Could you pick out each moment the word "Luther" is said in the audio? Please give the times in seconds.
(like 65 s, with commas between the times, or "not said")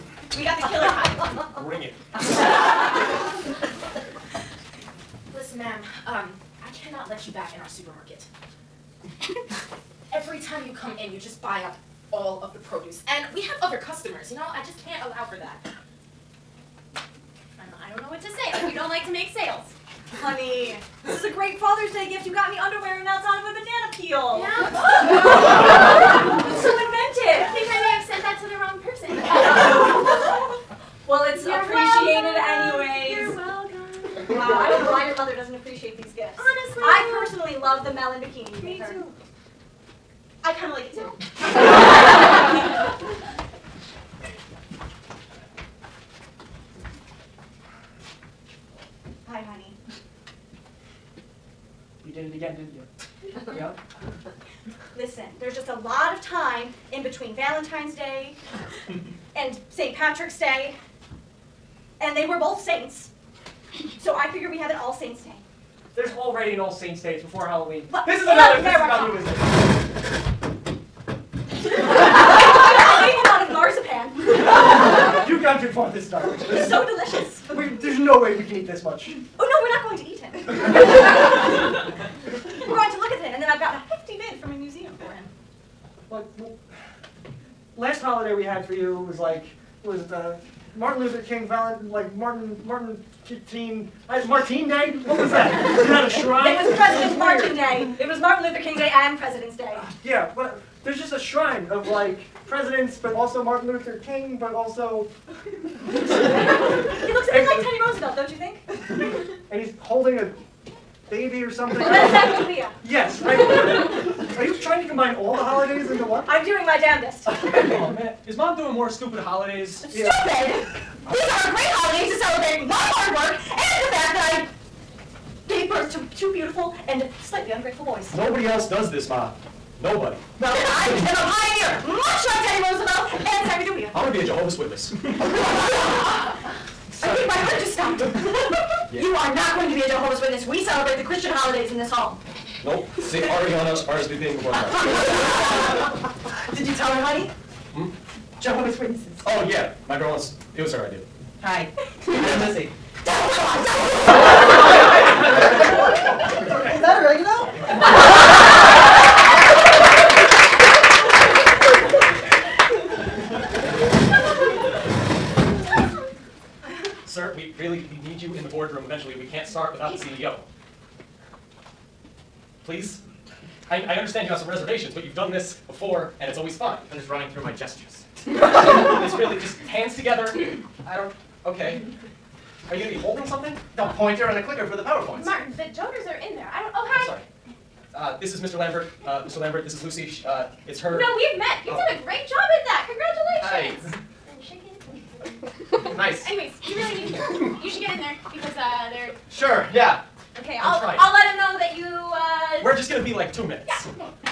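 90 s, 98 s, 103 s.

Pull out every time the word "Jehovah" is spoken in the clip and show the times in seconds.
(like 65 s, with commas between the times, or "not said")
134 s, 139 s, 148 s.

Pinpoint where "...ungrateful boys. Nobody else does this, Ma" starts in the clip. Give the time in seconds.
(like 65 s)
127 s.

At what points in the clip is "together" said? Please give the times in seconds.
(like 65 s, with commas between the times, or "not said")
179 s.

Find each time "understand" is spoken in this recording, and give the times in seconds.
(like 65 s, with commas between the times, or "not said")
174 s.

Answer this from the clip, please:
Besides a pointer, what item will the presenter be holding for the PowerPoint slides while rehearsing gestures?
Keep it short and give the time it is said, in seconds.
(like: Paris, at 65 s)
The clicker, at 184 s.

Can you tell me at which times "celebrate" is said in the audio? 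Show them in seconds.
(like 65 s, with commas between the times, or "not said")
122 s, 140 s.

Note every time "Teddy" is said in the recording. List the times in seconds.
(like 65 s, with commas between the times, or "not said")
107 s, 132 s.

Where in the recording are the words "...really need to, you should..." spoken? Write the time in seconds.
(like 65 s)
196 s.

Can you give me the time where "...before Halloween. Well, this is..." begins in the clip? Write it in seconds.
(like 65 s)
67 s.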